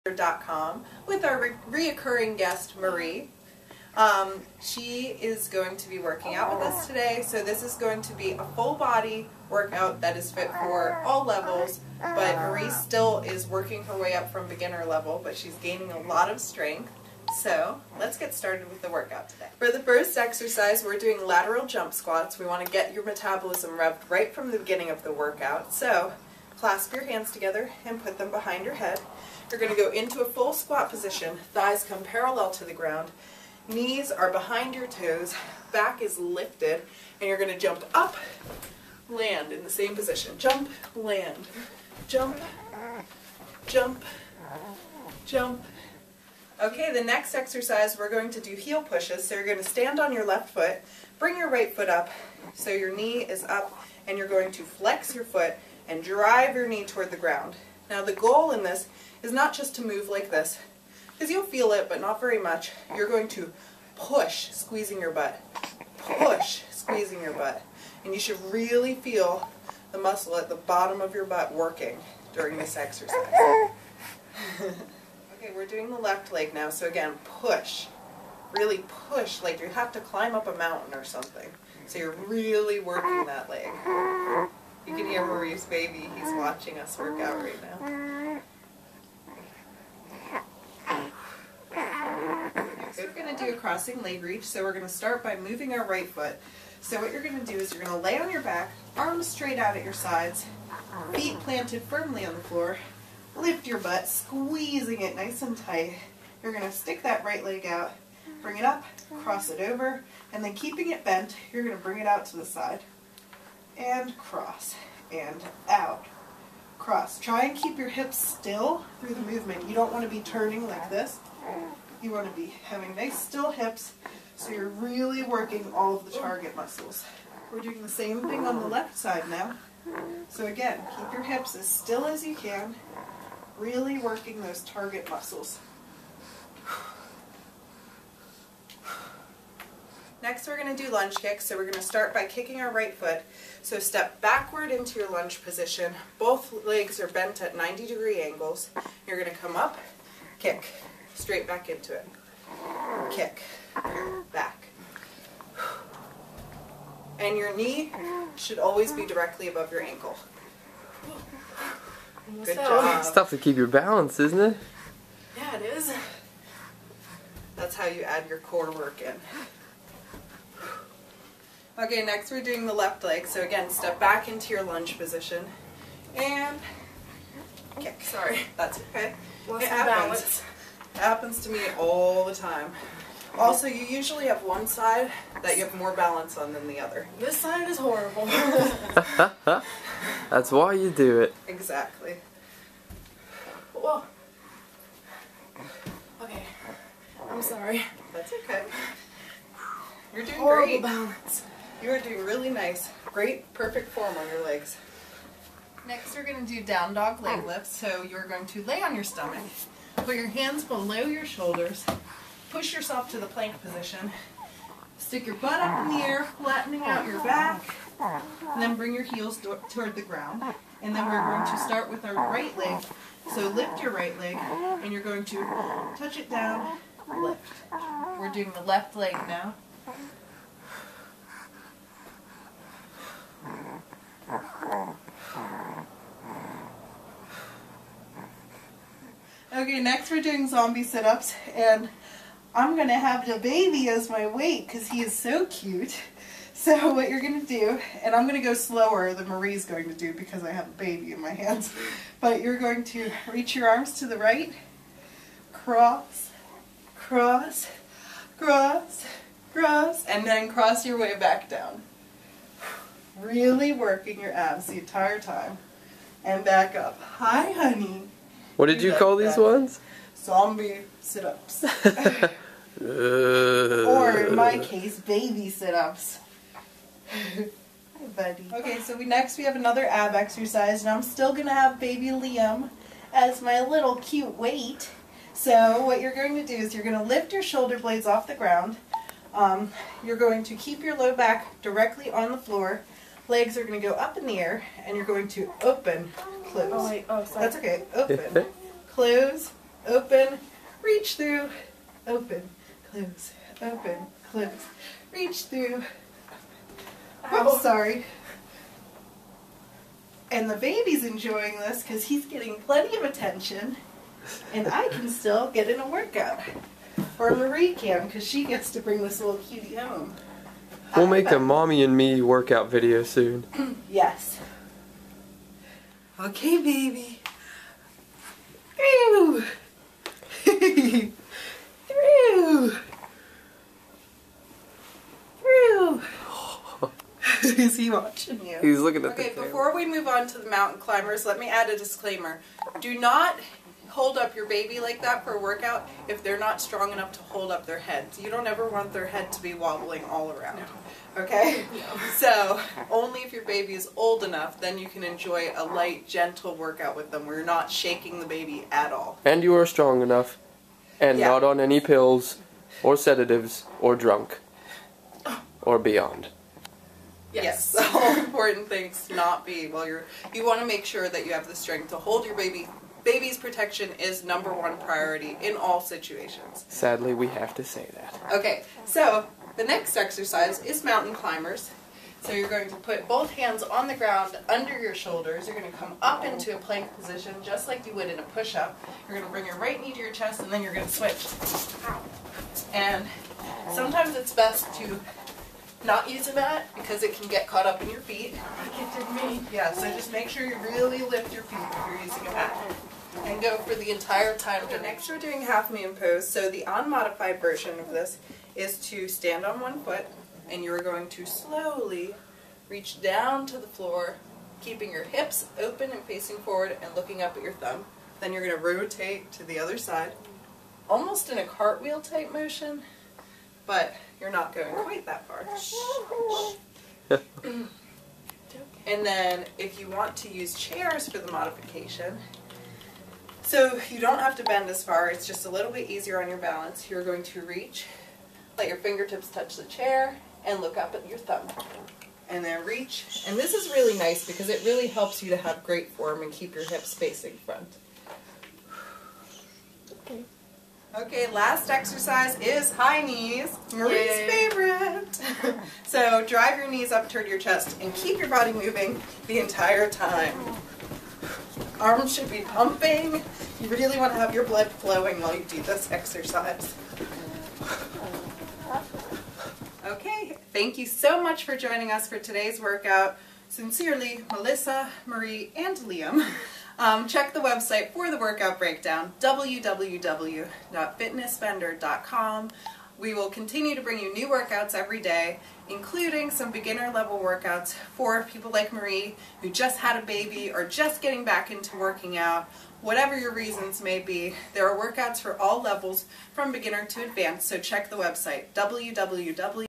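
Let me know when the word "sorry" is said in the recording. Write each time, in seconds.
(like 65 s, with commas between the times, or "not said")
178 s, 197 s, 297 s, 307 s.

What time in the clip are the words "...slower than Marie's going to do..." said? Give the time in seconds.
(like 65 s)
248 s.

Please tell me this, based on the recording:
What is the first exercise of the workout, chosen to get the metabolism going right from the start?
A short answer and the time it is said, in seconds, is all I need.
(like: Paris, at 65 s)
Lateral jump squats, at 21 s.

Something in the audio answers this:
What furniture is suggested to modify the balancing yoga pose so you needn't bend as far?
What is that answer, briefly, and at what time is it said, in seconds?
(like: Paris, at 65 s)
Chairs, at 430 s.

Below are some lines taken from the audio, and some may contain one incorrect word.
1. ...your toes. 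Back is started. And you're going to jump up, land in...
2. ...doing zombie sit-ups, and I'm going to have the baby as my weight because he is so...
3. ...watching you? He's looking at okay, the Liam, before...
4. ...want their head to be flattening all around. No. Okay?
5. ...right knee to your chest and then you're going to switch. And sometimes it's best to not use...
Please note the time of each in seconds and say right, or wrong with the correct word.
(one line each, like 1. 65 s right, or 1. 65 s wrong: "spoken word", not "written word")
1. 34 s wrong: "lifted", not "started"
2. 240 s right
3. 337 s wrong: "Okay", not "Liam"
4. 348 s wrong: "wobbling", not "flattening"
5. 389 s right.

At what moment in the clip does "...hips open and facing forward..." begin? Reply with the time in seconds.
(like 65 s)
415 s.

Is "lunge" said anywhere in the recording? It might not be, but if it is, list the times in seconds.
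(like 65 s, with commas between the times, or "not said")
140 s, 145 s, 174 s.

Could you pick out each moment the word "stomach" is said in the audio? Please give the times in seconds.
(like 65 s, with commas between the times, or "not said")
209 s.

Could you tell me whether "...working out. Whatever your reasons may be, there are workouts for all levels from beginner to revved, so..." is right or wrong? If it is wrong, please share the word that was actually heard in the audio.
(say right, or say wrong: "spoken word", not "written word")
wrong: "advanced", not "revved".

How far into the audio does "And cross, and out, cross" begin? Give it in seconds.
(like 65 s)
113 s.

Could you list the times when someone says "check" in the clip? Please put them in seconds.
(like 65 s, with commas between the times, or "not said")
477 s, 497 s.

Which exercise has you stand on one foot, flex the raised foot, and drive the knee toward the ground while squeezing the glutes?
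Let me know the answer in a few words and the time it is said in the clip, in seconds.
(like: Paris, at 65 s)
Heel pushes, at 48 s.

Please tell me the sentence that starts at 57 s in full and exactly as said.
Now the goal in this is not just to move like this, because you'll feel it, but not very much.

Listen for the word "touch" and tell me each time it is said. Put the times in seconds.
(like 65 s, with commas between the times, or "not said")
225 s, 439 s.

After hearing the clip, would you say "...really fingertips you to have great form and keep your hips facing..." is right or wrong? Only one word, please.
wrong.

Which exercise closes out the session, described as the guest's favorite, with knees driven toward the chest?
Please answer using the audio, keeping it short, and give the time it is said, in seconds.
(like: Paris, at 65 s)
High knees, at 452 s.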